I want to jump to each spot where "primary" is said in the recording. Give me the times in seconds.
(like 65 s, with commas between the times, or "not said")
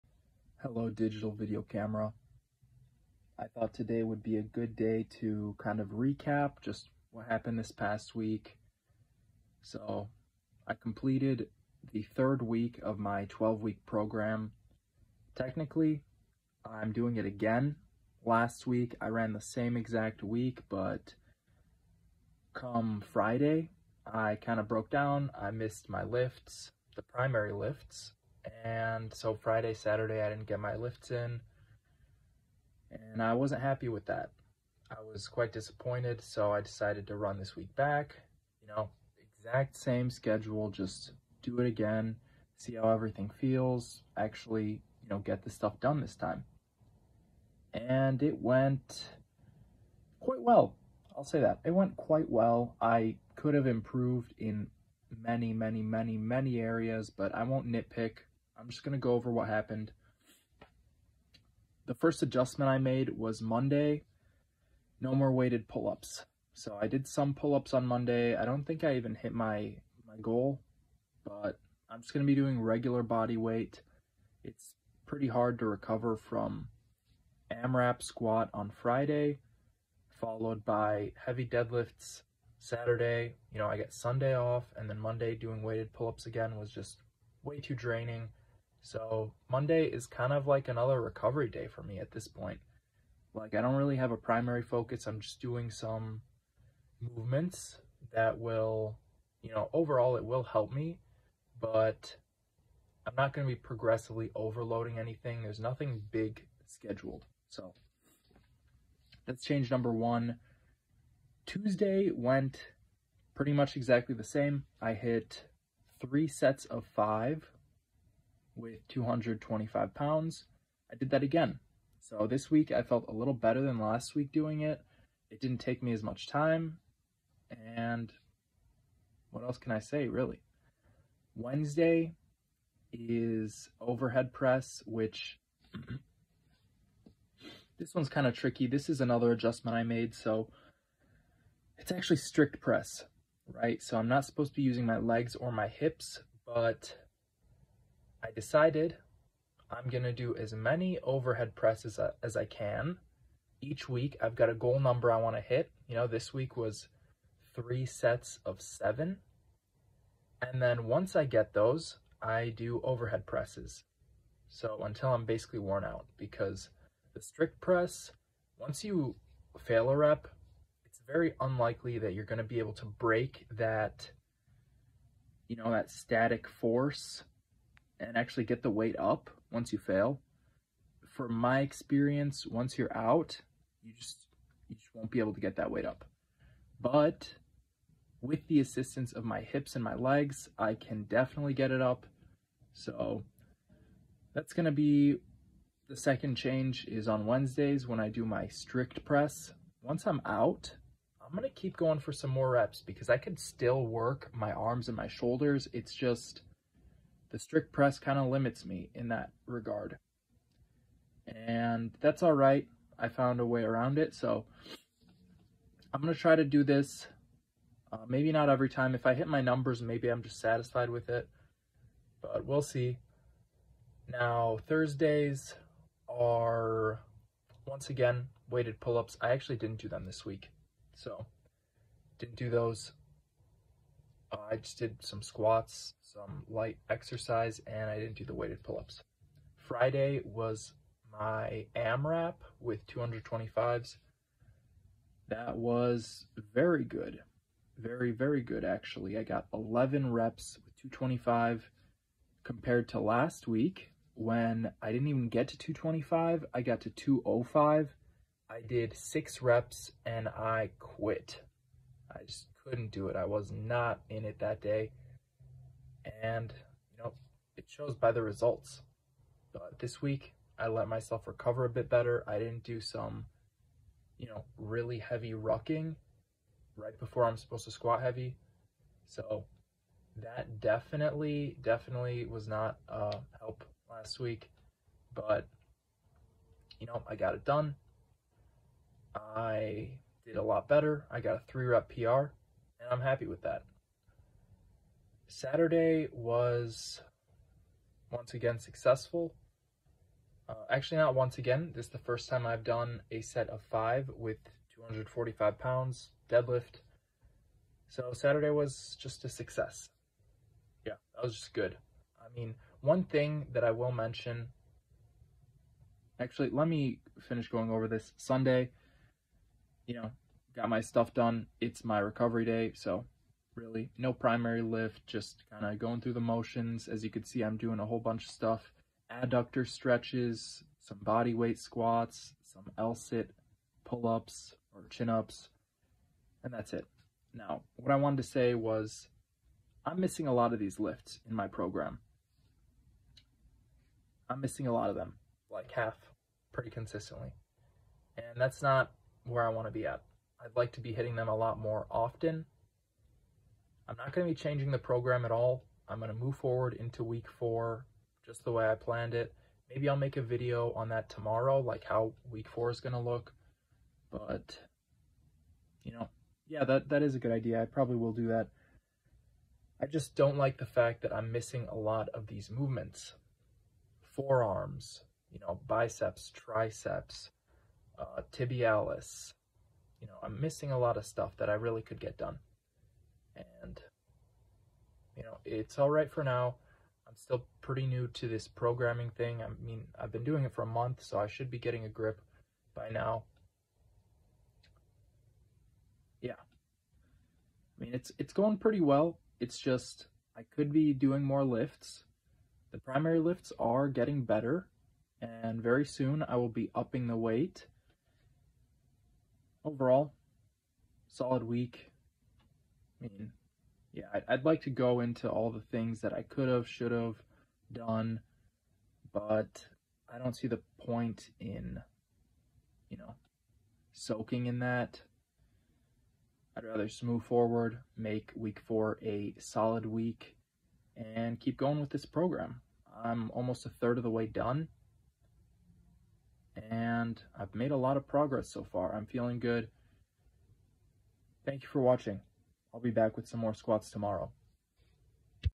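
27 s, 94 s, 324 s, 402 s.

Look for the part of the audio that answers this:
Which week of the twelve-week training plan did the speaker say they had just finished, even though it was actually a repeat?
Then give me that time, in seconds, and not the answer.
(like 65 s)
12 s.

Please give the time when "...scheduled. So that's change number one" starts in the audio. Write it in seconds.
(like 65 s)
106 s.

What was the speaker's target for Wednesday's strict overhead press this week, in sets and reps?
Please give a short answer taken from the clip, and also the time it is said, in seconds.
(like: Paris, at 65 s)
3 sets of 7, at 157 s.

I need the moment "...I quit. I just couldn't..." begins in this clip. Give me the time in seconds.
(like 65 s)
260 s.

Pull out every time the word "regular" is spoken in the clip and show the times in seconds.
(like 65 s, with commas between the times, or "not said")
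72 s.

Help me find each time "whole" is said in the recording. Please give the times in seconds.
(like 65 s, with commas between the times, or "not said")
327 s.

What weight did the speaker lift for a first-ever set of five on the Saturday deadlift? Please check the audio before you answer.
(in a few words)
245 pounds.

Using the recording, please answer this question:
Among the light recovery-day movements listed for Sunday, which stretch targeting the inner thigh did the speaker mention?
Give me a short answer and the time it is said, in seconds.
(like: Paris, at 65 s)
Adductor stretches, at 329 s.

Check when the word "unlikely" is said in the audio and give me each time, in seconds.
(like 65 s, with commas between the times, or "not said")
171 s.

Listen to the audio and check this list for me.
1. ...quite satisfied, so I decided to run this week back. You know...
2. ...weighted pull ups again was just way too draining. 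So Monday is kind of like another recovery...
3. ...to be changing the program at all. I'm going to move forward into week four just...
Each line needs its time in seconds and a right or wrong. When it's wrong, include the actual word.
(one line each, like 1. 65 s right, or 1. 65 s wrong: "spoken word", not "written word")
1. 35 s wrong: "disappointed", not "satisfied"
2. 85 s right
3. 354 s right.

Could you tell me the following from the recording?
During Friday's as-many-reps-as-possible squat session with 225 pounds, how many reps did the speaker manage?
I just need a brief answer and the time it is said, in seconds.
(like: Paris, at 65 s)
11, at 249 s.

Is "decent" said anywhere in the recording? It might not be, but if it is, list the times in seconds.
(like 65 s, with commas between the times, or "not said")
not said.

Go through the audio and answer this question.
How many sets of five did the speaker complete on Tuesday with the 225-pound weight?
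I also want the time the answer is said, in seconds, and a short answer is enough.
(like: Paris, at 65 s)
3, at 116 s.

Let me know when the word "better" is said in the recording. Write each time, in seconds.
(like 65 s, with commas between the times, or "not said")
123 s, 271 s, 290 s, 404 s.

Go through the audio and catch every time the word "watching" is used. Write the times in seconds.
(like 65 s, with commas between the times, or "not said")
441 s.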